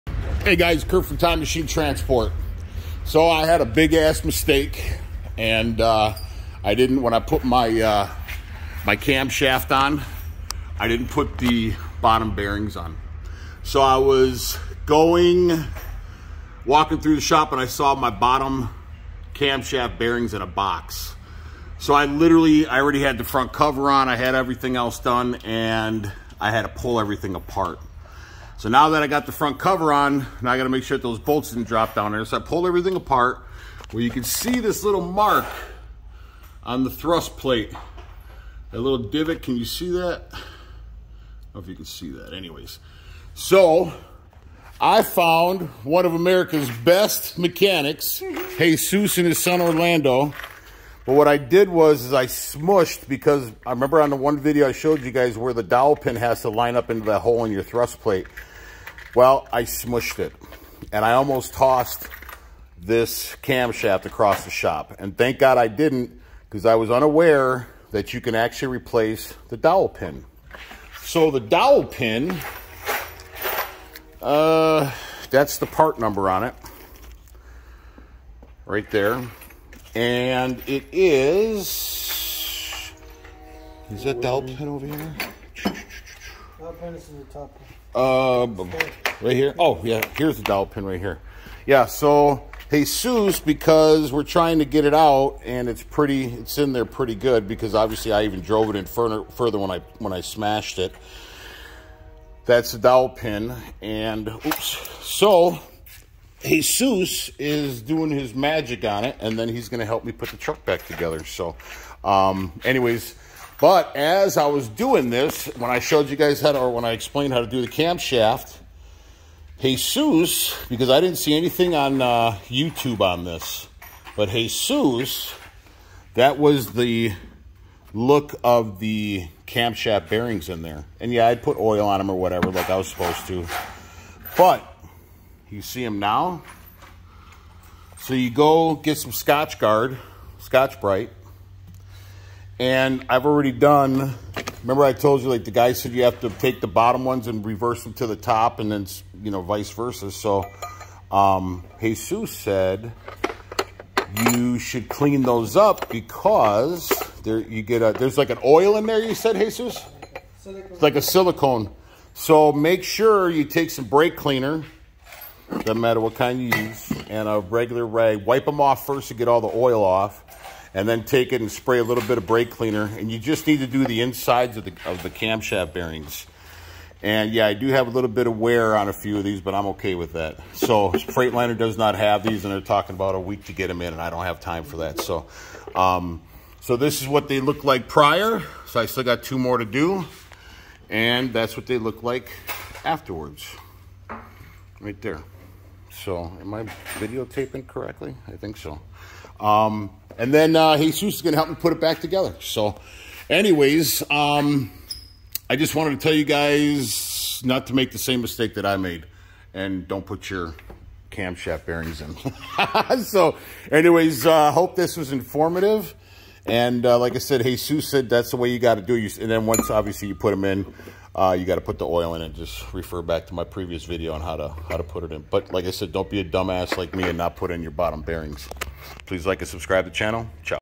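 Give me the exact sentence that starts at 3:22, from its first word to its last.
So, anyways, um, I just wanted to tell you guys not to make the same mistake that I made.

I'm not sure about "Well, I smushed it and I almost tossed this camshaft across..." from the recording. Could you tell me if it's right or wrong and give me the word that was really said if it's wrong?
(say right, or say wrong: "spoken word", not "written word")
right.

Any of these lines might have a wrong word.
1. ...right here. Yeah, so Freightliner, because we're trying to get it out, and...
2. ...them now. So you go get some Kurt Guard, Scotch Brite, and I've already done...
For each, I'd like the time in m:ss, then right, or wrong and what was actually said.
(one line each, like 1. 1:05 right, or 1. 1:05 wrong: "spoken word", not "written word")
1. 1:30 wrong: "Jesus", not "Freightliner"
2. 2:15 wrong: "Scotch", not "Kurt".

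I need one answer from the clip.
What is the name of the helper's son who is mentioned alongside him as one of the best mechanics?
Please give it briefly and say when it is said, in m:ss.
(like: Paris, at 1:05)
Orlando, at 0:49.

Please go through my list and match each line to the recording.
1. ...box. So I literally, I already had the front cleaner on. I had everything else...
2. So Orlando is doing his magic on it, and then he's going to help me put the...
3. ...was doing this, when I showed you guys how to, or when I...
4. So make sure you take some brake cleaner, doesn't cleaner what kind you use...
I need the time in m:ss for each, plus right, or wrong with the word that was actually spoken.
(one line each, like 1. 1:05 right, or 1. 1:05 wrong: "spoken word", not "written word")
1. 0:20 wrong: "cover", not "cleaner"
2. 1:45 wrong: "Jesus", not "Orlando"
3. 1:54 right
4. 2:42 wrong: "matter", not "cleaner".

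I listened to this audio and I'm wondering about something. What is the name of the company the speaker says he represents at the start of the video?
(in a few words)
Time Machine Transport.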